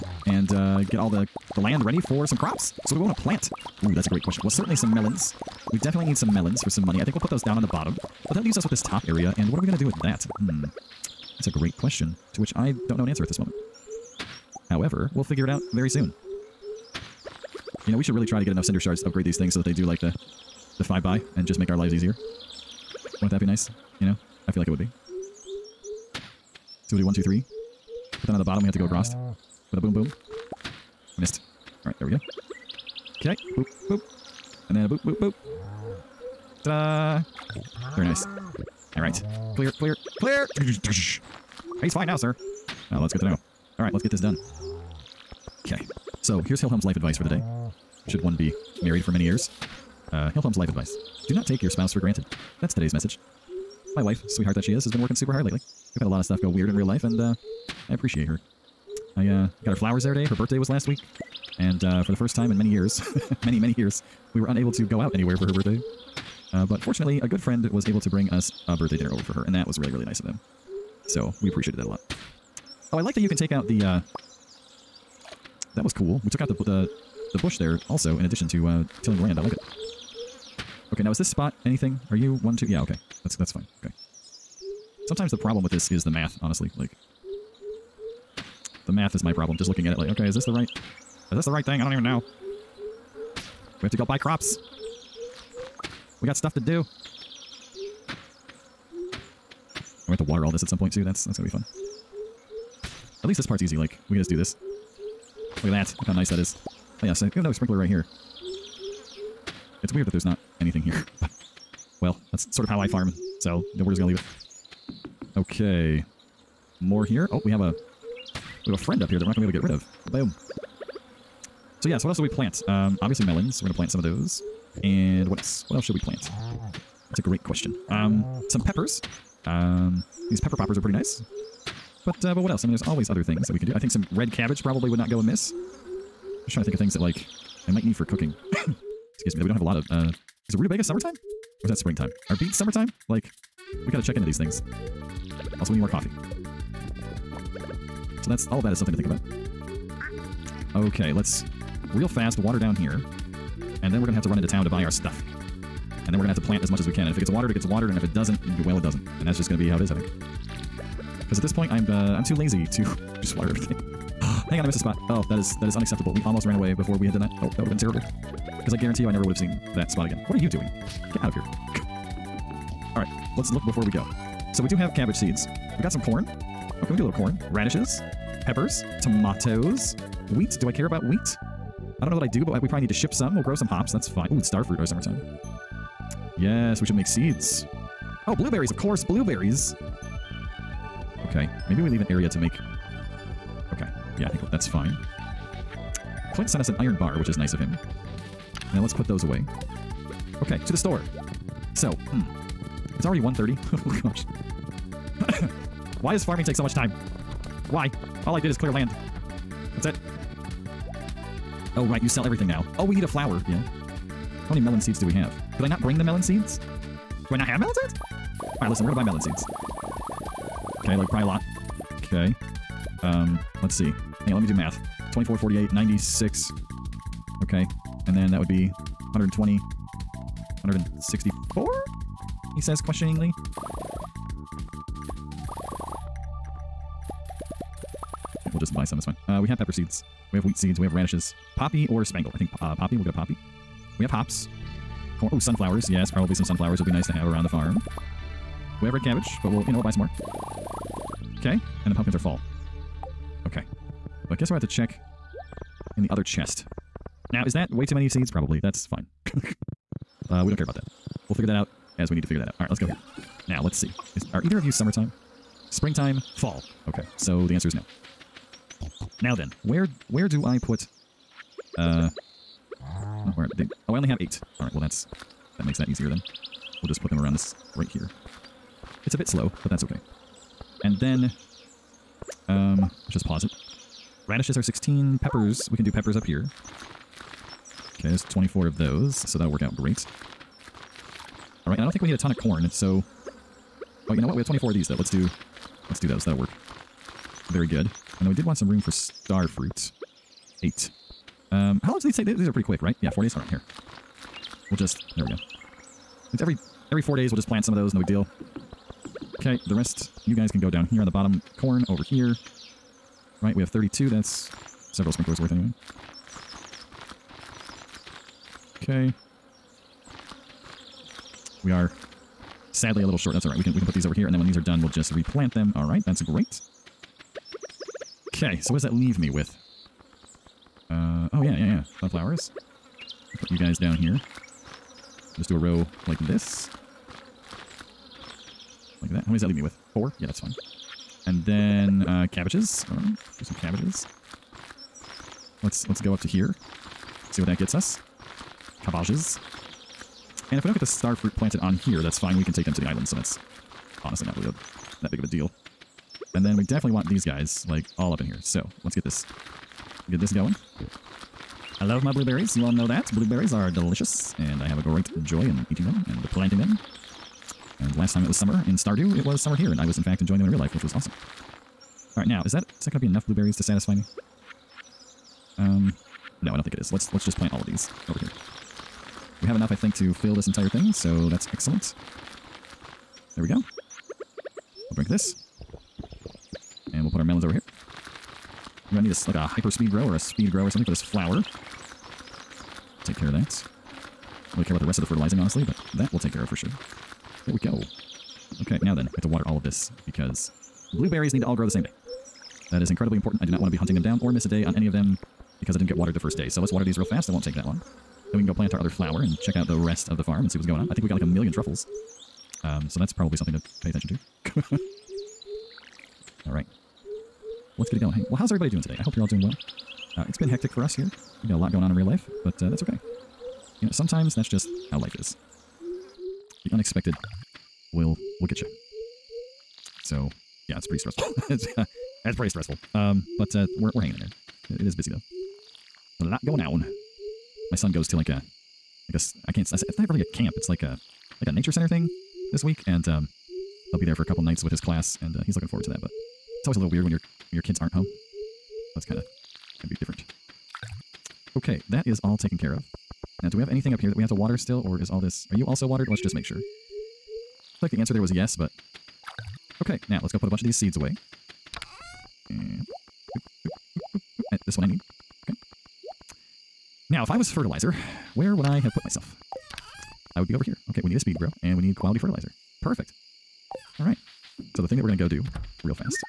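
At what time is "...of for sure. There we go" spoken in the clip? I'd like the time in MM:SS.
06:36.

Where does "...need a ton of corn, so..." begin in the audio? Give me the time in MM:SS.
04:52.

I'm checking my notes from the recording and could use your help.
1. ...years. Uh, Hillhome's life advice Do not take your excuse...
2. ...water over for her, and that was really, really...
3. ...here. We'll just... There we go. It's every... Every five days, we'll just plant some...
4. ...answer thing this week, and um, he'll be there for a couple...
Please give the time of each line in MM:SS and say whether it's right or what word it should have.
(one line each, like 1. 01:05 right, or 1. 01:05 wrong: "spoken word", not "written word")
1. 00:49 wrong: "spouse", not "excuse"
2. 01:08 wrong: "dinner", not "water"
3. 05:03 wrong: "four", not "five"
4. 07:21 wrong: "center", not "answer".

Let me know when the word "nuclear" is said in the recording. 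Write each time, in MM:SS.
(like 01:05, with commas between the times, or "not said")
not said.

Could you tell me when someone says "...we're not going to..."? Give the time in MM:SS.
01:59.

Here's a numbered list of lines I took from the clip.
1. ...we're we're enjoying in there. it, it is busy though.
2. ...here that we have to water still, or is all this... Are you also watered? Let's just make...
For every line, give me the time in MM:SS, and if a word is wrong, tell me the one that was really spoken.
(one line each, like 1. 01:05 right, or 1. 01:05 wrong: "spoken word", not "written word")
1. 07:13 wrong: "hanging", not "enjoying"
2. 07:33 right.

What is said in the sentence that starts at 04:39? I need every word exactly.
It's a bit slow, but that's okay.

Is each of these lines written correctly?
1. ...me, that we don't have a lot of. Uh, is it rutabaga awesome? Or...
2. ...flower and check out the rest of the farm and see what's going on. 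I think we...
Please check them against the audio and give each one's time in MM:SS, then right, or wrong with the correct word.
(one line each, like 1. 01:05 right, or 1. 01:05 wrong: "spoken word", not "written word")
1. 02:19 wrong: "summertime", not "awesome"
2. 06:48 right.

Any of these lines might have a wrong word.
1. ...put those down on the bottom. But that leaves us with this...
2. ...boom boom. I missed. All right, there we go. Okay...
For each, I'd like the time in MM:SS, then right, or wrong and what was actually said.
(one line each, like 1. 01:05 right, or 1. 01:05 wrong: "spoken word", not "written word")
1. 00:07 right
2. 00:29 right.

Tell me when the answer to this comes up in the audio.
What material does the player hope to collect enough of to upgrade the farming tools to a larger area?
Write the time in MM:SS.
00:18.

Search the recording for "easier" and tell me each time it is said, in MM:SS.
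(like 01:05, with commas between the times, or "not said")
00:21, 04:35.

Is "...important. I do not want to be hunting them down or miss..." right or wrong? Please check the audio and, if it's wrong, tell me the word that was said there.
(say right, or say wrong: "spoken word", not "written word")
right.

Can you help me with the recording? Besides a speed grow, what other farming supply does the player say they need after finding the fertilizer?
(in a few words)
Quality fertilizer.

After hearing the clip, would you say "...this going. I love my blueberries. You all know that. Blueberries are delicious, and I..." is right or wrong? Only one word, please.
right.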